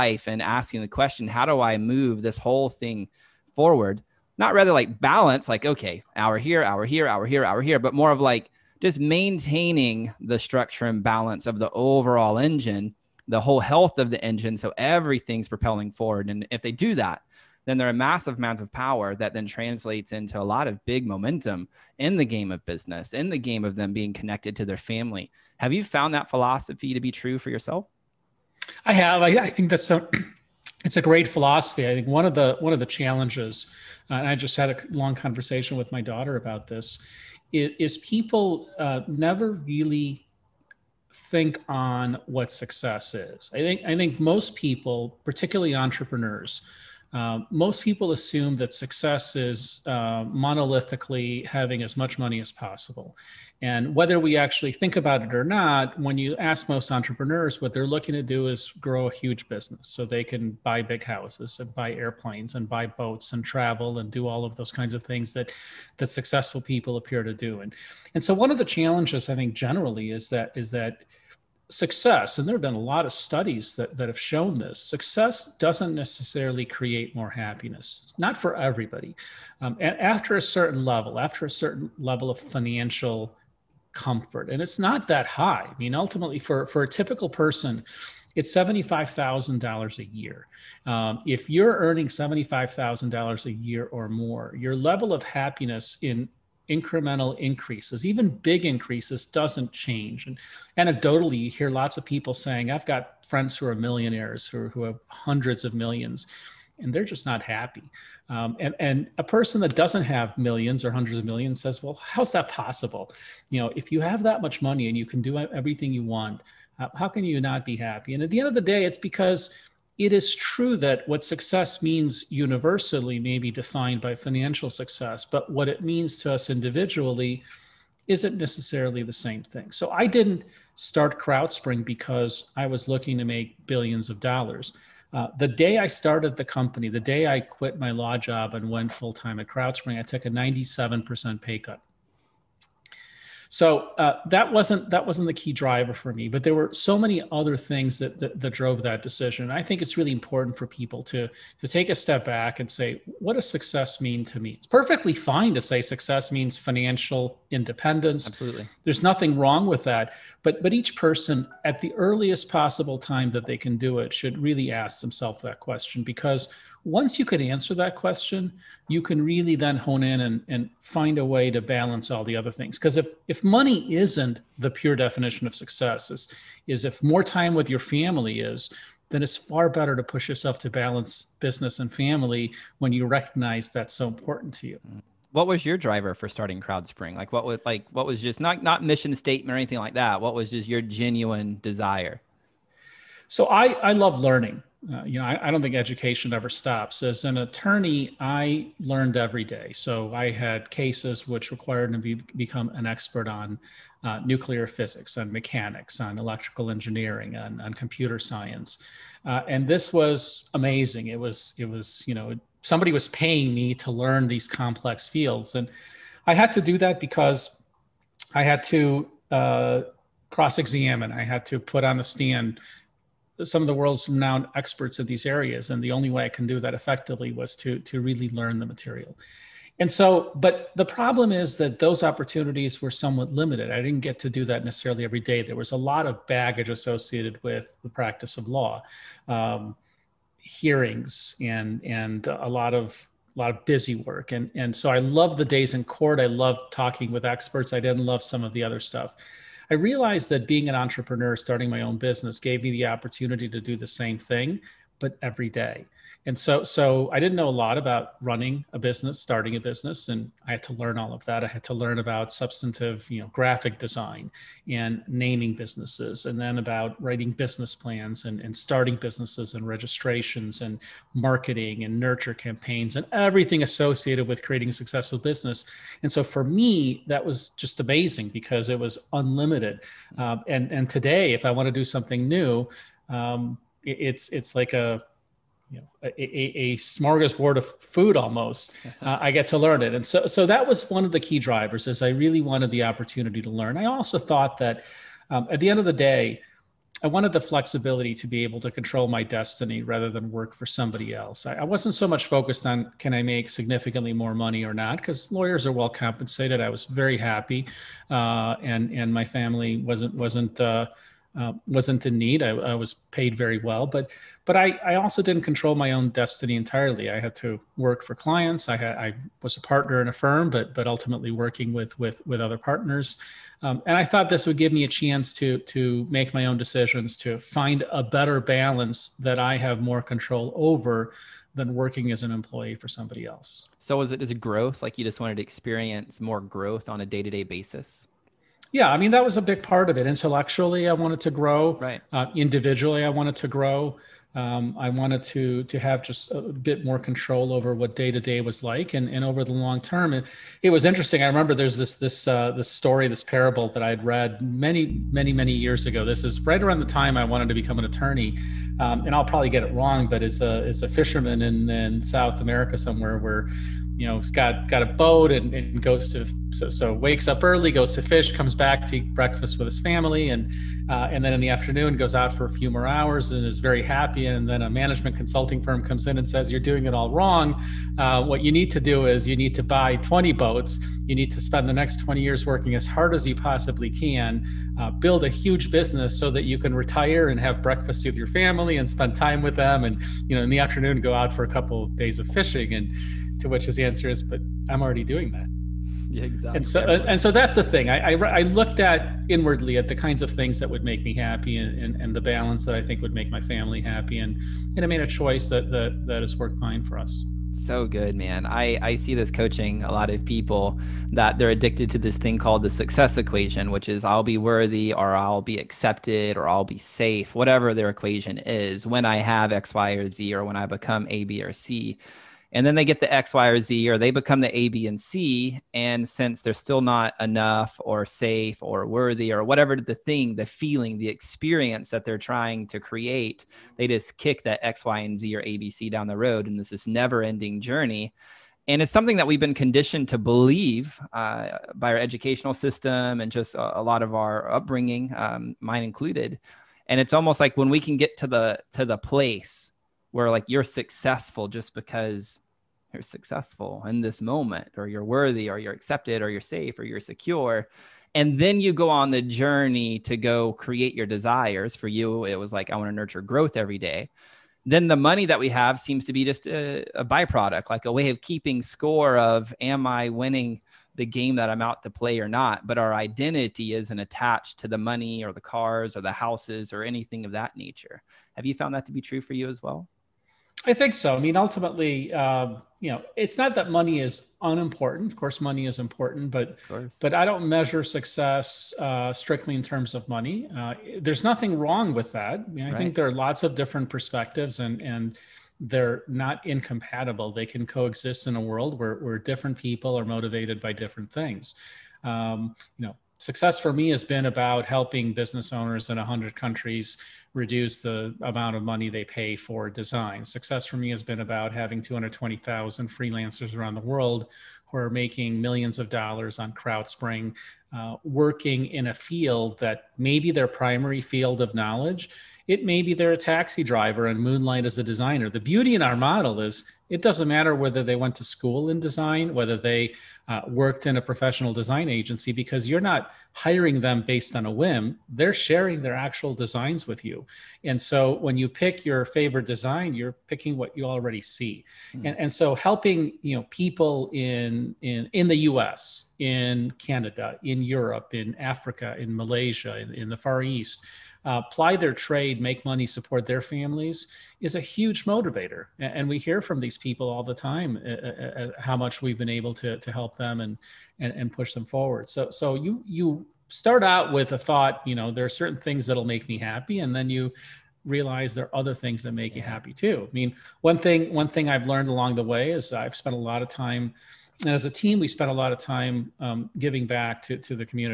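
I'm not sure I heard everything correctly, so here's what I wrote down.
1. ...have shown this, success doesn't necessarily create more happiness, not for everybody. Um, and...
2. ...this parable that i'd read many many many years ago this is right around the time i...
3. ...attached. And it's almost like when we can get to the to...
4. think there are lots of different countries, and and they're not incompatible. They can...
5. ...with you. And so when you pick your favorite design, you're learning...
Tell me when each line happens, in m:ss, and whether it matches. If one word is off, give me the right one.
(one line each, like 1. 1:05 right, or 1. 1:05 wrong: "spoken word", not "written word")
1. 1:14 right
2. 5:53 right
3. 7:25 wrong: "included", not "attached"
4. 8:12 wrong: "perspectives", not "countries"
5. 8:56 wrong: "picking", not "learning".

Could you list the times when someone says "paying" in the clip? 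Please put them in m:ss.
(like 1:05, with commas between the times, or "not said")
3:33.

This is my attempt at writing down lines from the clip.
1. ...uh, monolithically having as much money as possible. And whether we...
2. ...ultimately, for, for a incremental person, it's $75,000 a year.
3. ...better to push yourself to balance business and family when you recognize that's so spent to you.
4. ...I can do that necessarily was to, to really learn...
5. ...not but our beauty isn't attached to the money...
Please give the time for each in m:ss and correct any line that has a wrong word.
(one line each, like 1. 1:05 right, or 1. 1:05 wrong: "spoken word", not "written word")
1. 0:49 right
2. 1:25 wrong: "typical", not "incremental"
3. 2:59 wrong: "important", not "spent"
4. 3:46 wrong: "effectively", not "necessarily"
5. 7:52 wrong: "identity", not "beauty".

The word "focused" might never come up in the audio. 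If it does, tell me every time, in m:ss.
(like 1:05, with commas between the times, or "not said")
5:02.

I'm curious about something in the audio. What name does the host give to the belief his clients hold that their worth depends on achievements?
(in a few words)
success equation.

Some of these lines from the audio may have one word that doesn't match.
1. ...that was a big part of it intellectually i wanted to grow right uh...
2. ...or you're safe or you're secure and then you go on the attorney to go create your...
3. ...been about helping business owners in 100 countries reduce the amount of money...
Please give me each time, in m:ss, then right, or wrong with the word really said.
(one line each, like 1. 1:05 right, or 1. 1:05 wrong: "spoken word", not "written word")
1. 5:39 right
2. 7:36 wrong: "journey", not "attorney"
3. 8:24 right.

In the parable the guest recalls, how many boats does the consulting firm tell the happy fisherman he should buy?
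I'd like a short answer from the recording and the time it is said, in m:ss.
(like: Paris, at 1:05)
20, at 6:19.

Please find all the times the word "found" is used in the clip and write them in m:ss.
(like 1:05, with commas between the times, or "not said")
0:25, 7:58.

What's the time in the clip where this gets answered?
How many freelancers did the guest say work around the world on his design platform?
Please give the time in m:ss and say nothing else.
8:31.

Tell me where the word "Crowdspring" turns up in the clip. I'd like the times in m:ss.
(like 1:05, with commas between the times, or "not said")
2:11, 2:19, 3:06, 8:36.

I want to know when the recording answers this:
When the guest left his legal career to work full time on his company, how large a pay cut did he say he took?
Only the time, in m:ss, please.
2:20.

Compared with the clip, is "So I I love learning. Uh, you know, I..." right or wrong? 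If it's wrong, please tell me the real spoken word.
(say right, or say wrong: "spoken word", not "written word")
right.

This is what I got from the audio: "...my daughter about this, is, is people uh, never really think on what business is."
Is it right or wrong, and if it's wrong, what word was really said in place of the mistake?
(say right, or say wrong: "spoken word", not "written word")
wrong: "success", not "business".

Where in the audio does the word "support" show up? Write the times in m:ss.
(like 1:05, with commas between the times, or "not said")
9:12.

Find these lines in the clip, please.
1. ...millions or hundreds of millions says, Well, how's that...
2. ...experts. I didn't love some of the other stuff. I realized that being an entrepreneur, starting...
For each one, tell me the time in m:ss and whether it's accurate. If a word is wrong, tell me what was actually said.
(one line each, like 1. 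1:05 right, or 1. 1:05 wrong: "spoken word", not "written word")
1. 1:50 right
2. 4:07 right.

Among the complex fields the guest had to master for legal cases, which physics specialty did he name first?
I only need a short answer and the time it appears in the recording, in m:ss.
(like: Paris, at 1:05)
nuclear physics, at 3:24.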